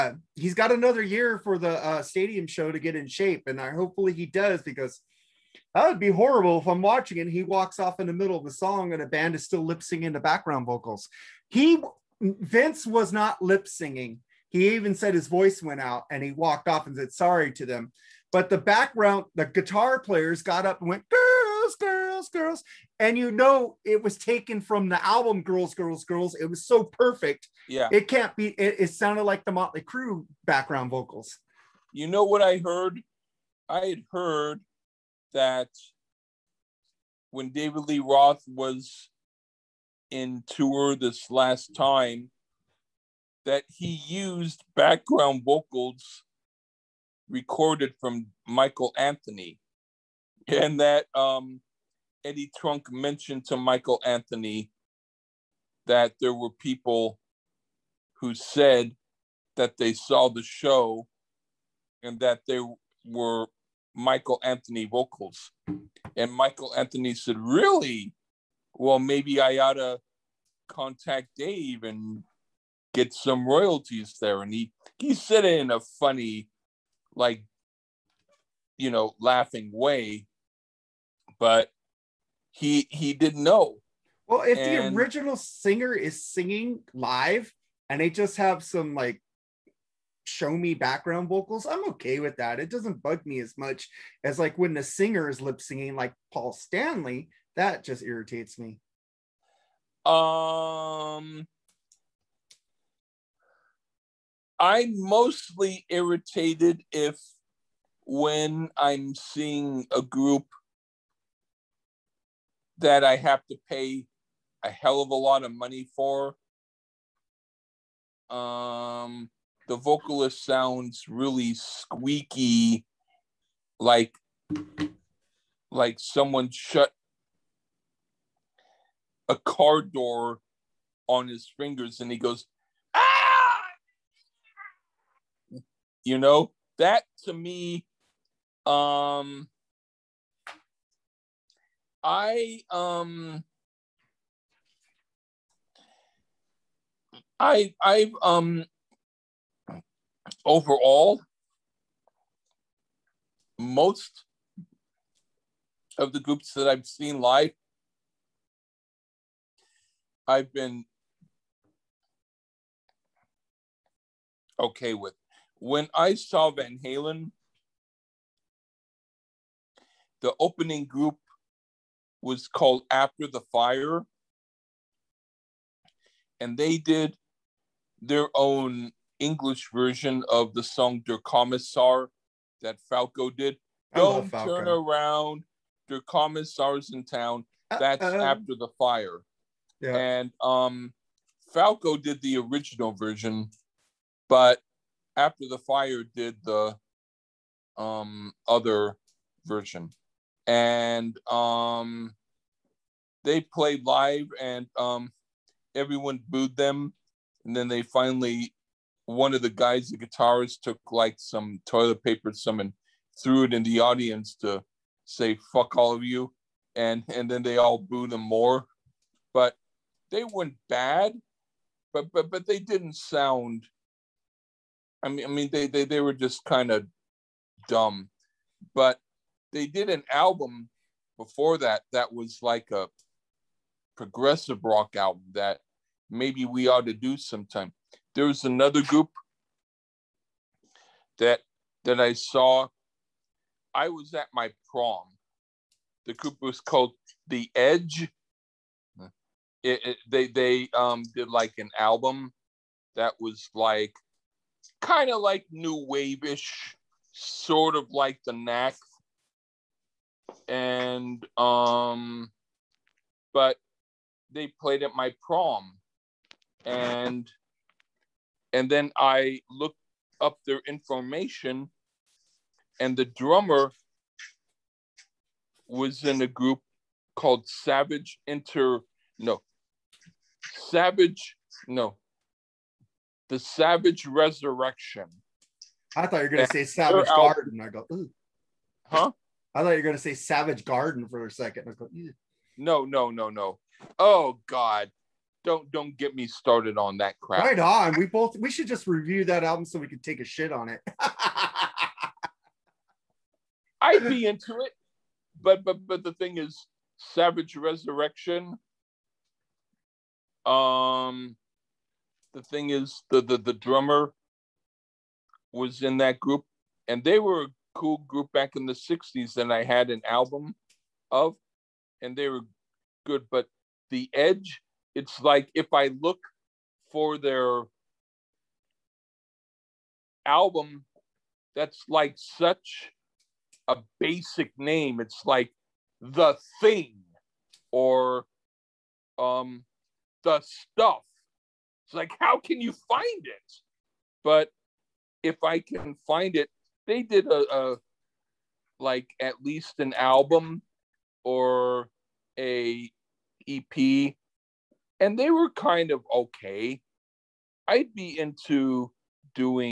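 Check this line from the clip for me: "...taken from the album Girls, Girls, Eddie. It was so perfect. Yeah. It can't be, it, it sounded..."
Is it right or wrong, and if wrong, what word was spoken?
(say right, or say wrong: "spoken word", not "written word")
wrong: "Girls", not "Eddie".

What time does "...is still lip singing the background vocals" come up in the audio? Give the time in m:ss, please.
0:09.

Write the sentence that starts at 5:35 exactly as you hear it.
It's like The Thing or um, The Stuff.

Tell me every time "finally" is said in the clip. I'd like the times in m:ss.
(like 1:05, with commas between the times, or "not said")
3:27.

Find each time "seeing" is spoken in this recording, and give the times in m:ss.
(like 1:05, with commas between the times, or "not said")
1:49.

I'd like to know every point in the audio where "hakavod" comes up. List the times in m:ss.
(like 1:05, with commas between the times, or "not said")
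not said.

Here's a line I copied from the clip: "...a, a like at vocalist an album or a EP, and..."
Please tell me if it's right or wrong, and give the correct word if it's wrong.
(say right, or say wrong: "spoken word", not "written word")
wrong: "least", not "vocalist".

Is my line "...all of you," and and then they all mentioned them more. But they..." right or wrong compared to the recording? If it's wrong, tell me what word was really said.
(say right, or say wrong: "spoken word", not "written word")
wrong: "booed", not "mentioned".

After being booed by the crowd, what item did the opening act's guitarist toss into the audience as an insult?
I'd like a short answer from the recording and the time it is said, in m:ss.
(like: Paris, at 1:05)
toilet paper, at 3:31.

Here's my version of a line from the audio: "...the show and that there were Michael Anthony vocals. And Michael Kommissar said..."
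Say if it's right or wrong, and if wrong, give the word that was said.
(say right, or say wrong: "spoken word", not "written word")
wrong: "Anthony", not "Kommissar".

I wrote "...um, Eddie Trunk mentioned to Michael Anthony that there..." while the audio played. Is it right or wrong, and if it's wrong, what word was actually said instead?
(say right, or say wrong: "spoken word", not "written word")
right.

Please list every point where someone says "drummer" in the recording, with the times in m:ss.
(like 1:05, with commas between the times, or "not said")
4:33, 5:13.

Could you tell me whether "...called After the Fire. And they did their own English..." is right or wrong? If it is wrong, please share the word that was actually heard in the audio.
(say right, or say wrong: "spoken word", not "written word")
right.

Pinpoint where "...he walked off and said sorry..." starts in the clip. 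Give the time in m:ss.
0:16.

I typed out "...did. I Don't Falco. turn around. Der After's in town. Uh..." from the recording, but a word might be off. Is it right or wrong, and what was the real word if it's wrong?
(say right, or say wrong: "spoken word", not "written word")
wrong: "Kommissar", not "After".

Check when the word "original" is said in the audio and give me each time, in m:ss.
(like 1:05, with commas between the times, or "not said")
1:24, 3:12.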